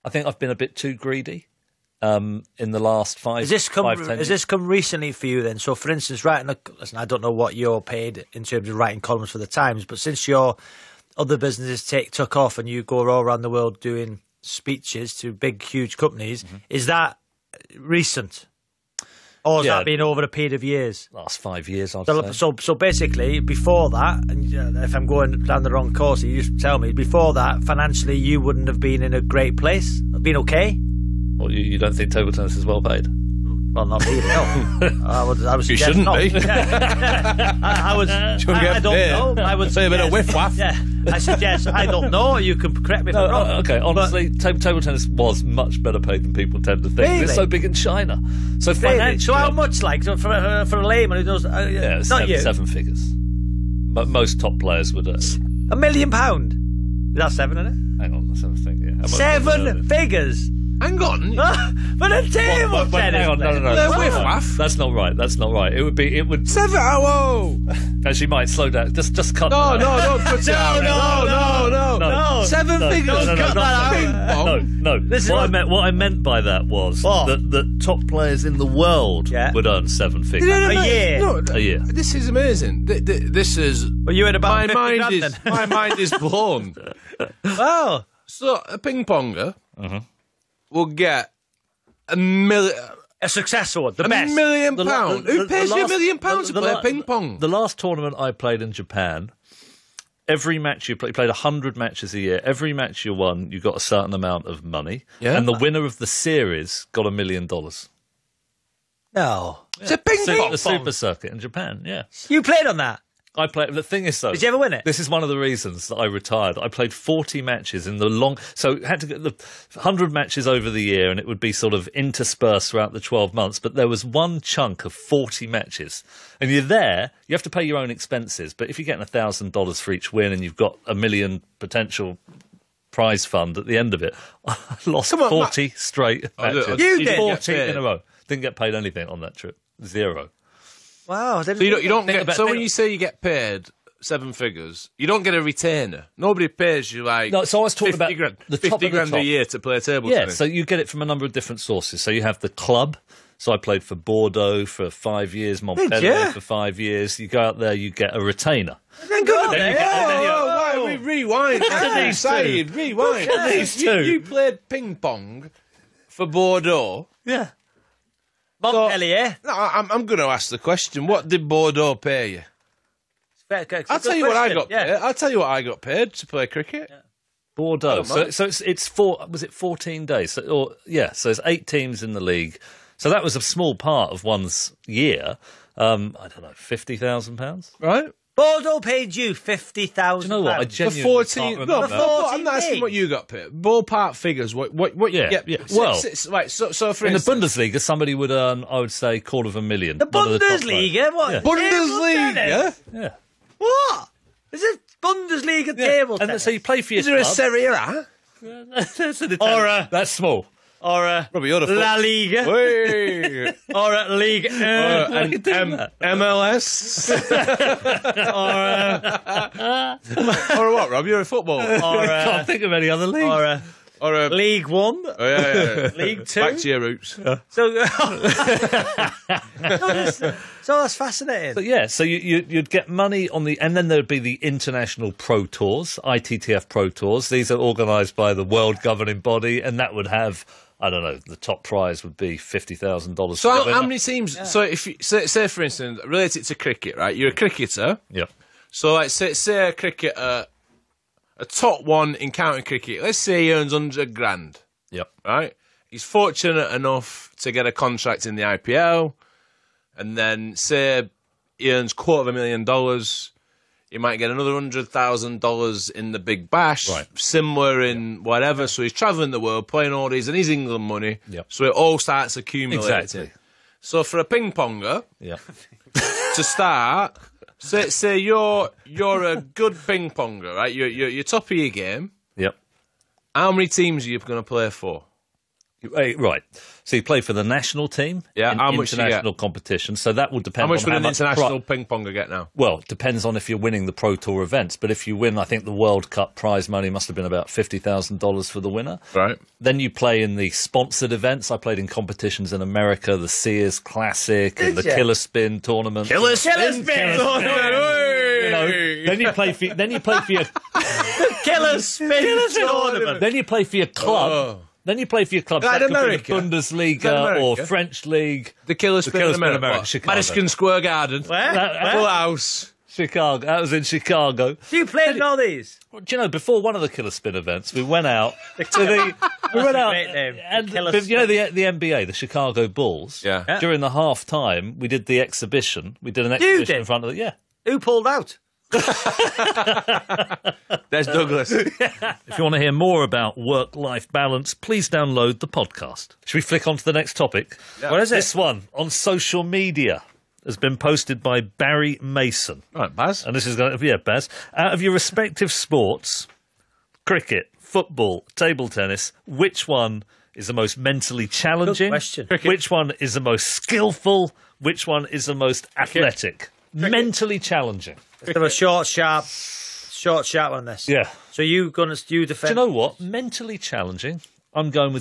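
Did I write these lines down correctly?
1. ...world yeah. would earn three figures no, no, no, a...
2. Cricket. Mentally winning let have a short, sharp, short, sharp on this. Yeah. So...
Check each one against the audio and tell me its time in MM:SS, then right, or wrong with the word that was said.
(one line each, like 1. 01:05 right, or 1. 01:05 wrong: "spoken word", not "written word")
1. 01:18 wrong: "seven", not "three"
2. 06:06 wrong: "challenging", not "winning".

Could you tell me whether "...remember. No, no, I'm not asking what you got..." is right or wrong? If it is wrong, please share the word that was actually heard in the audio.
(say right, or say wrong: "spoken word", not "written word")
right.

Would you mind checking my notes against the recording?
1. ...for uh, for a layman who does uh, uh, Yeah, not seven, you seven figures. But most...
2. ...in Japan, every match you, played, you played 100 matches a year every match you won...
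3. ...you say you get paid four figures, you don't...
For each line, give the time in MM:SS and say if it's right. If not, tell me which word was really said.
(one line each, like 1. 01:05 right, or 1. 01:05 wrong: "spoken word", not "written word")
1. 00:50 right
2. 01:38 right
3. 02:22 wrong: "seven", not "four".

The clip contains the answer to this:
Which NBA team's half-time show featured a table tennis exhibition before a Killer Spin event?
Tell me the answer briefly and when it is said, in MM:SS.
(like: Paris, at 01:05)
Chicago Bulls, at 05:32.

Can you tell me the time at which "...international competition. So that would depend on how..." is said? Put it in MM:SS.
04:48.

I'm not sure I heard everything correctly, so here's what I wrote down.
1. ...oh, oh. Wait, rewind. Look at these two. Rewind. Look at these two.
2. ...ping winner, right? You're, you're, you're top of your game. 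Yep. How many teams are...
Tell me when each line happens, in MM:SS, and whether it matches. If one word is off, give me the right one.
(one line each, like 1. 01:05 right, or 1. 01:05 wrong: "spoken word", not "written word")
1. 02:40 right
2. 04:39 wrong: "ponger", not "winner".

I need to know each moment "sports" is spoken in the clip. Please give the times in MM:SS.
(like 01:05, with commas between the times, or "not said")
05:55.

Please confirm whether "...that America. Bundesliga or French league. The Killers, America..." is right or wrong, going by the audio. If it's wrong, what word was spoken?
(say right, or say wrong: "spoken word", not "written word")
wrong: "Spin", not "America".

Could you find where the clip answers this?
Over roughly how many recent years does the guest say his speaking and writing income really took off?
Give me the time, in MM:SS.
00:21.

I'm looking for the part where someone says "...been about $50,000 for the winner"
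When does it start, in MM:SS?
04:57.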